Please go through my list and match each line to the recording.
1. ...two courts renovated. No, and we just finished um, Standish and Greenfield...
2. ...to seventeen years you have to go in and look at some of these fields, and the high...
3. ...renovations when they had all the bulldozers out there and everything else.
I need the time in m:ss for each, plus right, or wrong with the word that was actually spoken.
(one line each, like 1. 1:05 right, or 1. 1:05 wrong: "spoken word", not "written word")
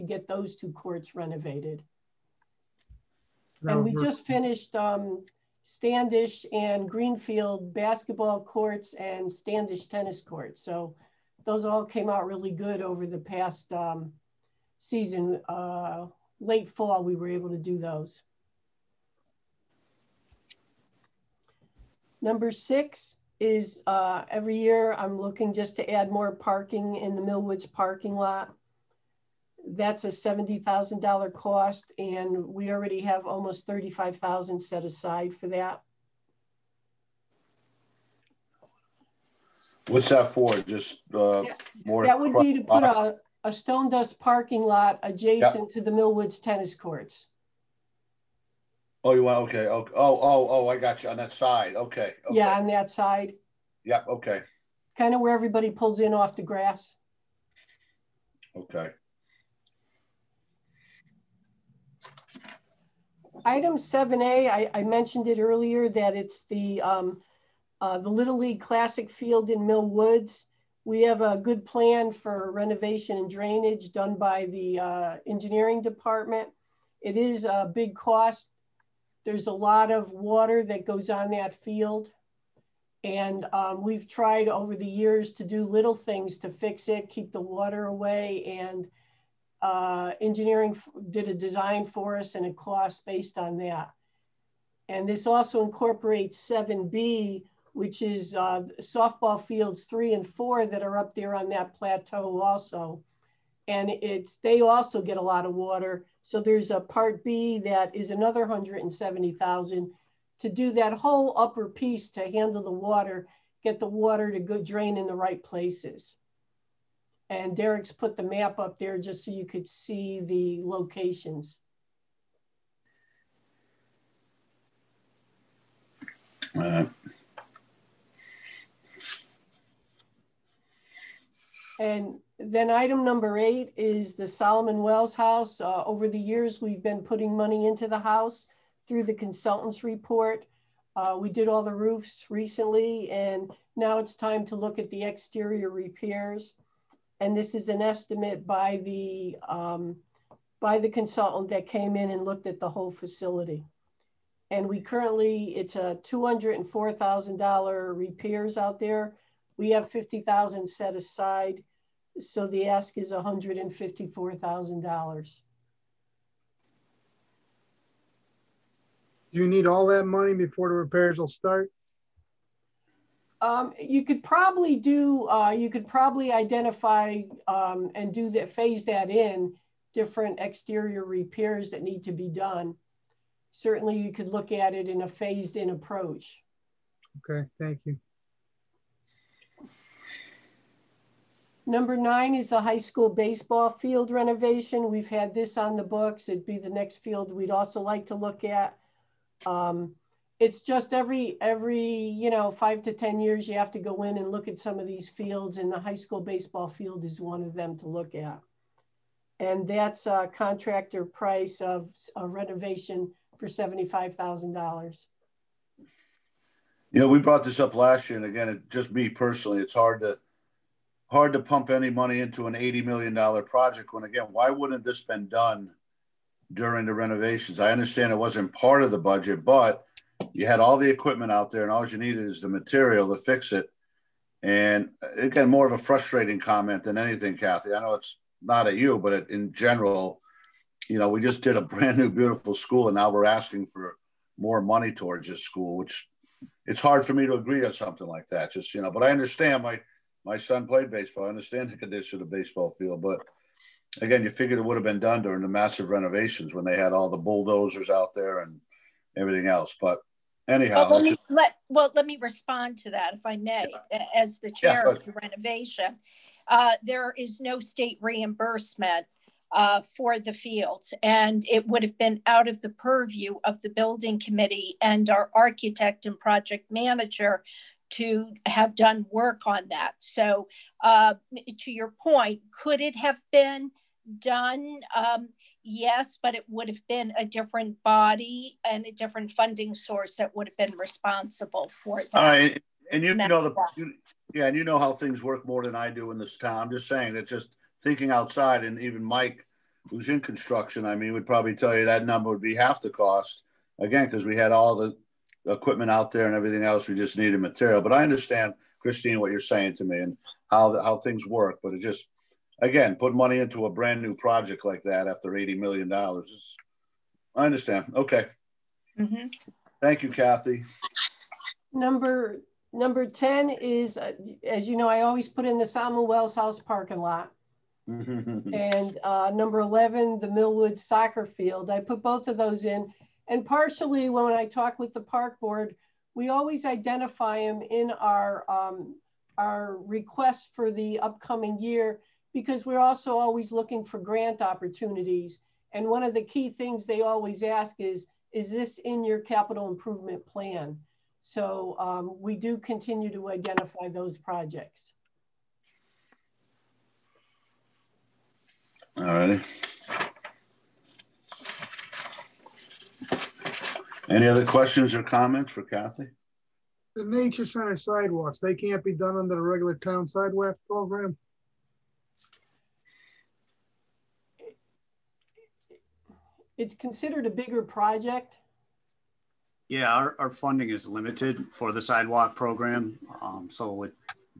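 1. 0:00 right
2. 3:22 wrong: "ten", not "seventeen"
3. 4:15 right.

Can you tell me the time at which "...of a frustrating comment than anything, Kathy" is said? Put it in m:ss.
3:55.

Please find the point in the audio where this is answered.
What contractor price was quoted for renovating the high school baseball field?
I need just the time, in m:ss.
3:33.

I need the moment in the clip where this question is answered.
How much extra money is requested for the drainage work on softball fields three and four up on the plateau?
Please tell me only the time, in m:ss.
1:48.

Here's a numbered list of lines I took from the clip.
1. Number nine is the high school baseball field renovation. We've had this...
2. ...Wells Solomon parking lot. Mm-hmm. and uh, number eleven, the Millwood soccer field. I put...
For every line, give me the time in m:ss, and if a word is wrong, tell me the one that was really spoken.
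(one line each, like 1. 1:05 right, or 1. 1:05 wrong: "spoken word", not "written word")
1. 3:11 right
2. 5:26 wrong: "House", not "Solomon".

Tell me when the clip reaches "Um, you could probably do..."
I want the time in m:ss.
2:53.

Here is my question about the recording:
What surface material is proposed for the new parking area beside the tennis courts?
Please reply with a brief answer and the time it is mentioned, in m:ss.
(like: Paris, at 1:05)
stone dust, at 0:43.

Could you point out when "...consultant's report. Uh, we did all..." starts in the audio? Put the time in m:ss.
2:19.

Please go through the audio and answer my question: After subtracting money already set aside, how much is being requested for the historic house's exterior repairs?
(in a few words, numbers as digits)
$154,000.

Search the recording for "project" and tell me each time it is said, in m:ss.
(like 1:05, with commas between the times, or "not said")
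3:43, 4:36, 5:14, 5:54, 6:17.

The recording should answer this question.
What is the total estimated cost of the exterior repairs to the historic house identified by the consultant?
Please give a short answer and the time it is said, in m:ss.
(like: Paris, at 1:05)
$204,000, at 2:36.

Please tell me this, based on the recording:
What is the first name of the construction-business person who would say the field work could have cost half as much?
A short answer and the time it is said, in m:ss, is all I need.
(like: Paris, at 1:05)
Mike, at 4:59.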